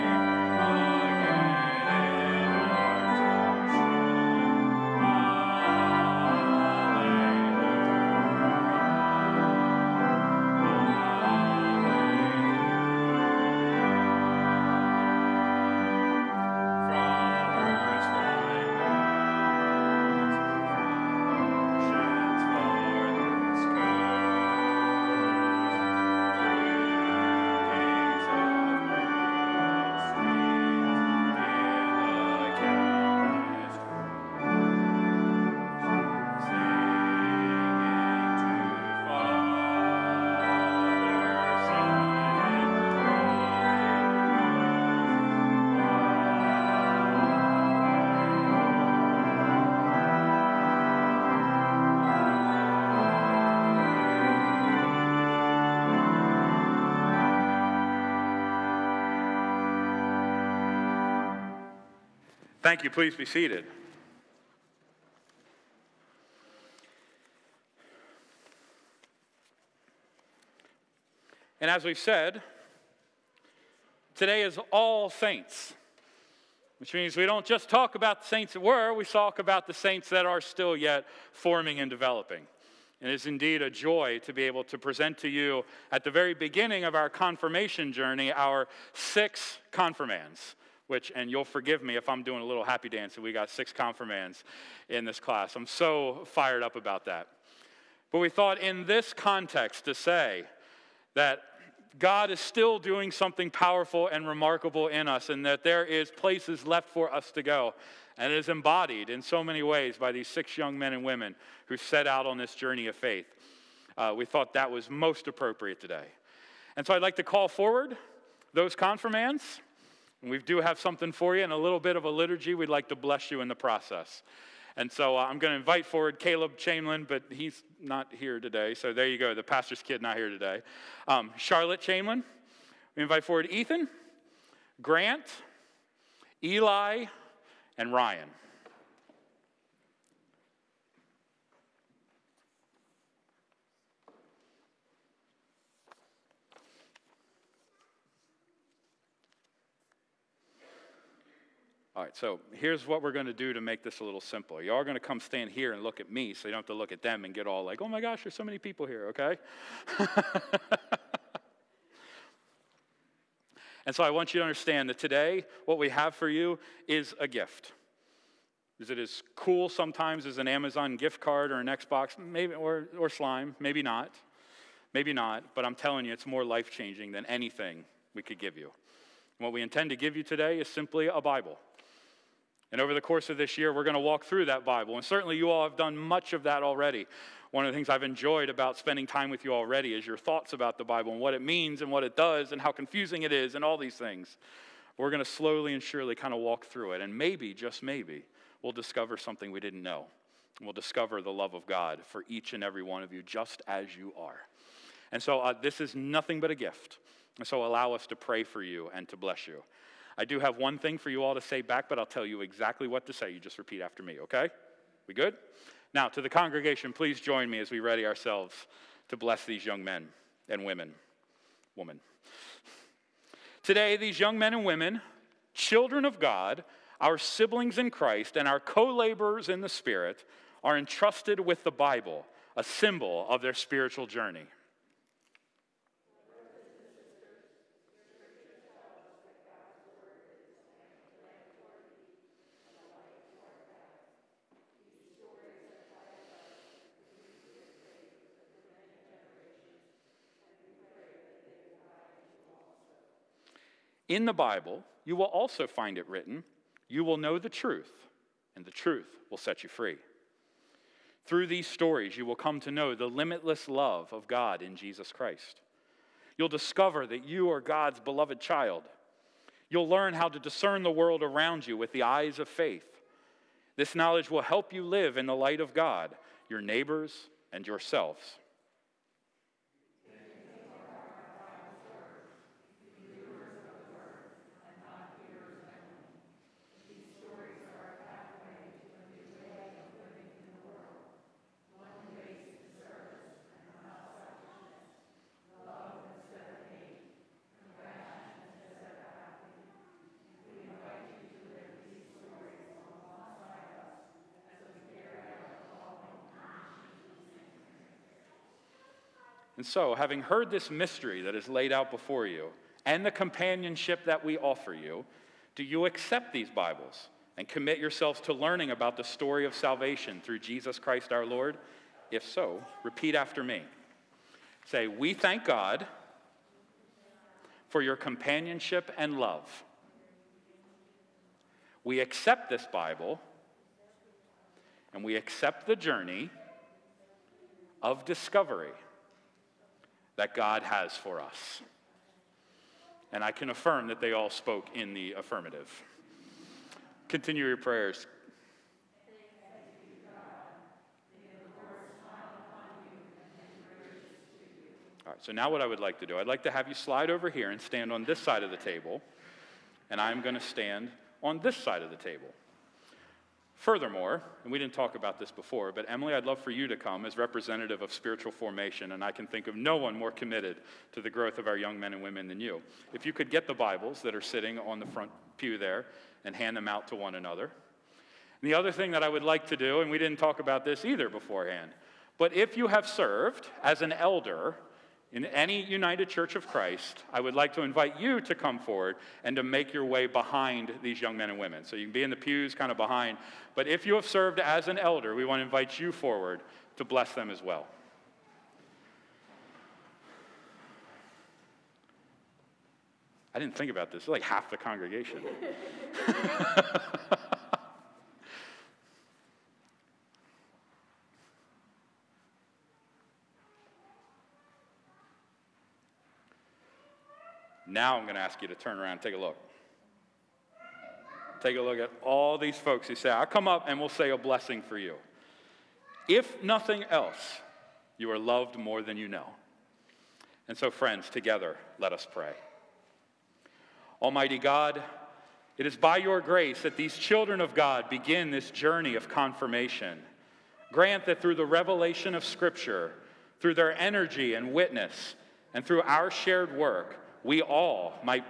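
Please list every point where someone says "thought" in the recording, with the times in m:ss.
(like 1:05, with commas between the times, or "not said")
1:38, 1:54, 3:10.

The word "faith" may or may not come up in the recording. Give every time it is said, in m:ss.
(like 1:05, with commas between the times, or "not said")
1:52, 4:32.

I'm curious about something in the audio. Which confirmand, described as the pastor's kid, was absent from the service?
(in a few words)
Caleb Chamlin.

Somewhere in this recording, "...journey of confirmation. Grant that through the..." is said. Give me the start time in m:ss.
7:18.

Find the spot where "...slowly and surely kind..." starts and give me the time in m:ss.
3:15.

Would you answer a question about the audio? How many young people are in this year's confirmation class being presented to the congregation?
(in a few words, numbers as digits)
6.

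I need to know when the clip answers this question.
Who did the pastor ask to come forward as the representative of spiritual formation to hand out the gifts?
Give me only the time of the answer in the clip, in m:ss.
6:05.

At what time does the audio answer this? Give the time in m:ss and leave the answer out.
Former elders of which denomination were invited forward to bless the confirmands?
6:25.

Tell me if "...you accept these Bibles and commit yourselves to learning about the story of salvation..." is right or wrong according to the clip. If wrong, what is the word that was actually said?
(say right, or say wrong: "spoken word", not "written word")
right.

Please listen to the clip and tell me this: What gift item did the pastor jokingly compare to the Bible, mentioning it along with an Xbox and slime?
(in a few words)
Amazon gift card.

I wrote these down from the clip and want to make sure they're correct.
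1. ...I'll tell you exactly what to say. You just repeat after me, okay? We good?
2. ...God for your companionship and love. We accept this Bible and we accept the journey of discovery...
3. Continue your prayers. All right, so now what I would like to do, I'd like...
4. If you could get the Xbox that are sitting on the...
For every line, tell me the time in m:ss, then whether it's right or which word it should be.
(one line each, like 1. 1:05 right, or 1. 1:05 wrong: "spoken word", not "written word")
1. 3:31 right
2. 5:25 right
3. 5:47 right
4. 6:12 wrong: "Bibles", not "Xbox".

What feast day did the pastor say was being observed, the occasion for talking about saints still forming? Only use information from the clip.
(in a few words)
All Saints.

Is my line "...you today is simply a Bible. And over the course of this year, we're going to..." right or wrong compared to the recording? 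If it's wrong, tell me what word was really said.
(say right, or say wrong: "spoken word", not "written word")
right.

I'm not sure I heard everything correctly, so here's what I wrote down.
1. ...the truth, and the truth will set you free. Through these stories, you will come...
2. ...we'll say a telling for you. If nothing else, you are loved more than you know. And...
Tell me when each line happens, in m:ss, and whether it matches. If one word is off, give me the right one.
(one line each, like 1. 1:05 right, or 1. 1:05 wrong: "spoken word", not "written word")
1. 4:17 right
2. 7:03 wrong: "blessing", not "telling".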